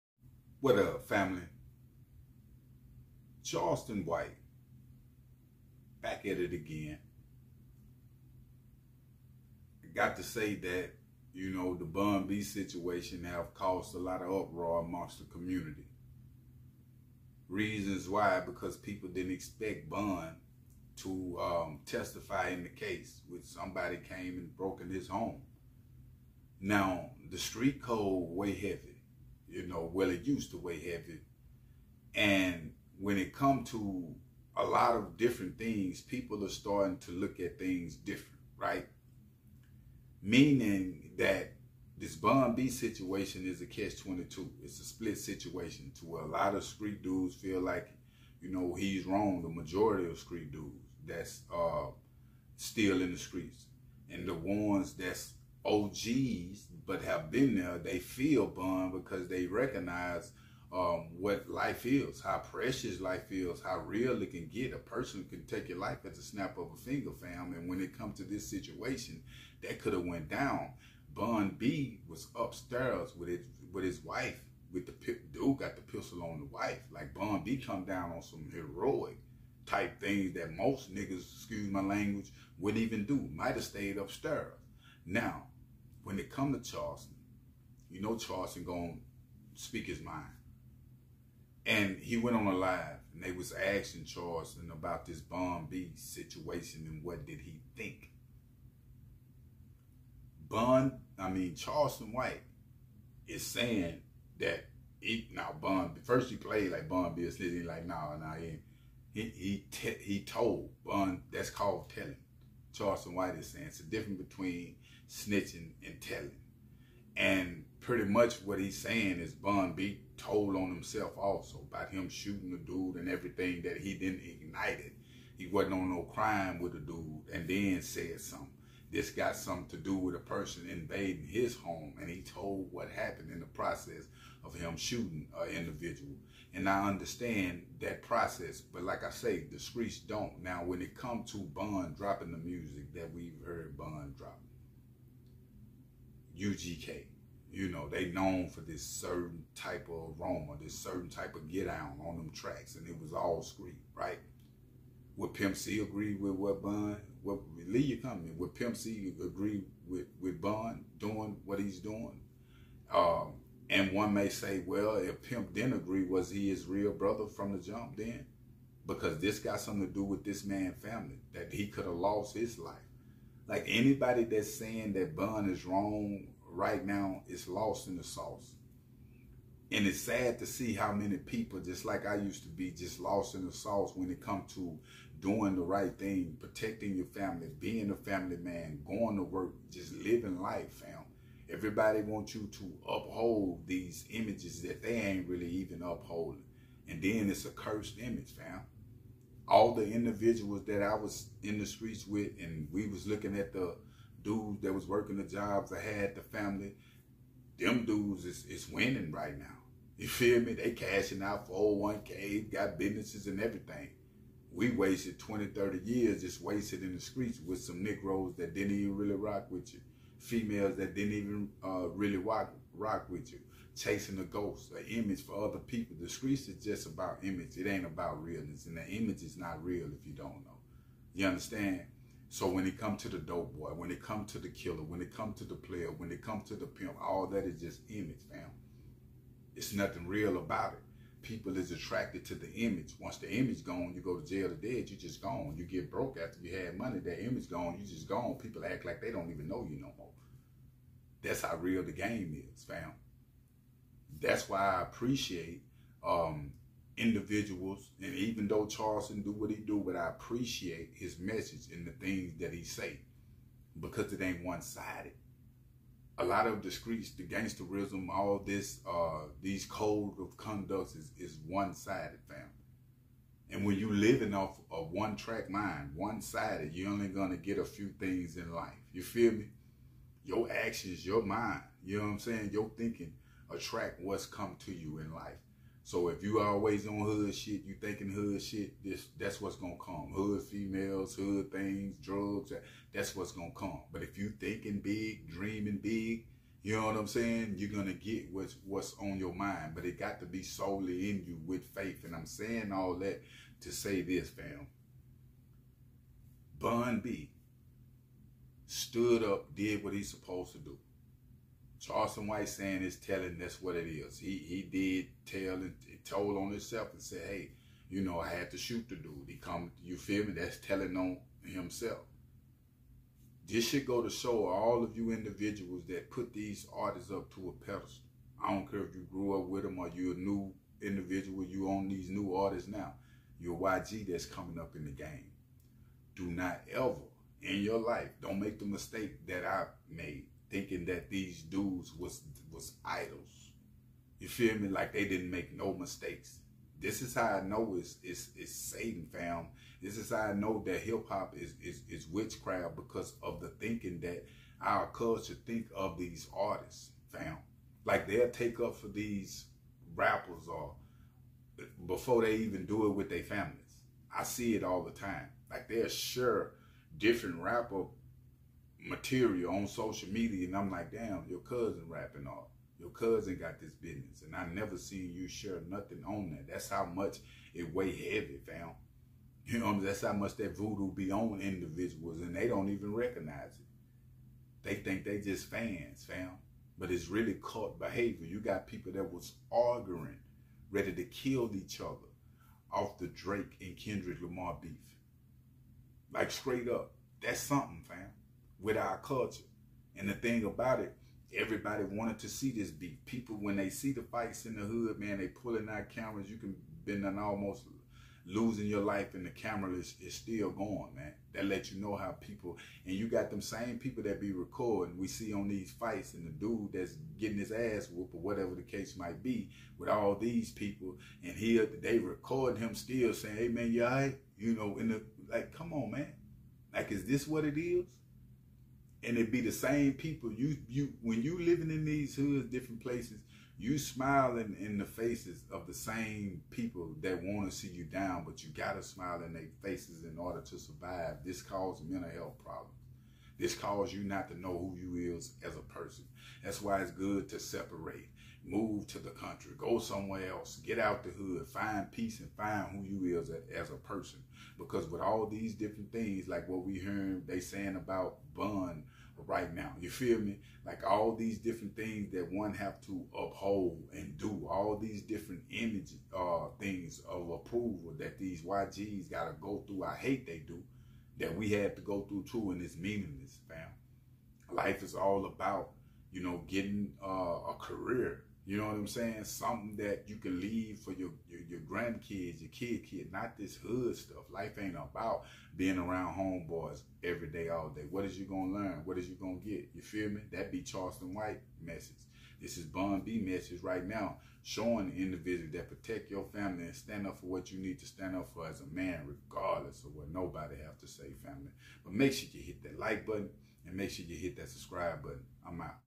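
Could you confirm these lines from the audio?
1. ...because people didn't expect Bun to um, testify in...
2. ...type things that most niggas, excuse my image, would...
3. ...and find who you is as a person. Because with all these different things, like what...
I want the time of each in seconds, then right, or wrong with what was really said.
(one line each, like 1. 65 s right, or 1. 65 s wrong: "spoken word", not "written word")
1. 18 s right
2. 79 s wrong: "language", not "image"
3. 452 s right.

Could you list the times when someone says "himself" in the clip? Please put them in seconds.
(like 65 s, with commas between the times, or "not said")
120 s, 316 s, 321 s.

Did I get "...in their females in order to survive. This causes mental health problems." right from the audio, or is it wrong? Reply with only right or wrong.
wrong.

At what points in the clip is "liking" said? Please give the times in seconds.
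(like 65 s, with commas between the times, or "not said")
not said.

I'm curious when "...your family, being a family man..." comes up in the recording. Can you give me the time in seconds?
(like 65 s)
186 s.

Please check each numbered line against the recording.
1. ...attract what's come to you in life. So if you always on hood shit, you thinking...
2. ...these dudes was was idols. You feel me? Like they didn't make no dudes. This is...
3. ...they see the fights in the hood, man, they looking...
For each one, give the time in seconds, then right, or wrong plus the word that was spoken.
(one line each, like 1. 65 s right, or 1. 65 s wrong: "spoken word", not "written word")
1. 283 s right
2. 341 s wrong: "mistakes", not "dudes"
3. 403 s wrong: "pulling", not "looking".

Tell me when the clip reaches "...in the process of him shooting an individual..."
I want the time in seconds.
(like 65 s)
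133 s.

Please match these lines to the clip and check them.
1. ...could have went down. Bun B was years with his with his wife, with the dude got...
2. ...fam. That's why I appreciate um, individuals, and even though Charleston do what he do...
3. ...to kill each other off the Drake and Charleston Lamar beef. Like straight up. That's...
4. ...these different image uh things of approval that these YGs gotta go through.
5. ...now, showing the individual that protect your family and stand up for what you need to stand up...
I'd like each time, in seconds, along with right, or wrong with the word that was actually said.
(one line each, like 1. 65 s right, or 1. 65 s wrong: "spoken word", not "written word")
1. 69 s wrong: "upstairs", not "years"
2. 252 s right
3. 390 s wrong: "Kendrick", not "Charleston"
4. 464 s right
5. 493 s right.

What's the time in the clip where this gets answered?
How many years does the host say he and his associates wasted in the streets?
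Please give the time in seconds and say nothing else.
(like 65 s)
215 s.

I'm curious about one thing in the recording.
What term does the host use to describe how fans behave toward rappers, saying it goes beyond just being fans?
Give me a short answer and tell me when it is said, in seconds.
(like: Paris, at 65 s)
cult behavior, at 387 s.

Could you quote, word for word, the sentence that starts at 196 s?
And then it's a cursed image, fam.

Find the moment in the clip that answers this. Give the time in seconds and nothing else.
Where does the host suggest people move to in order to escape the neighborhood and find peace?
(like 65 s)
448 s.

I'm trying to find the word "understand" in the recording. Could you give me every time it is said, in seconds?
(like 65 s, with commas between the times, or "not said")
136 s, 231 s.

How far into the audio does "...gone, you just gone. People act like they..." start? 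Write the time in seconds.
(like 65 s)
247 s.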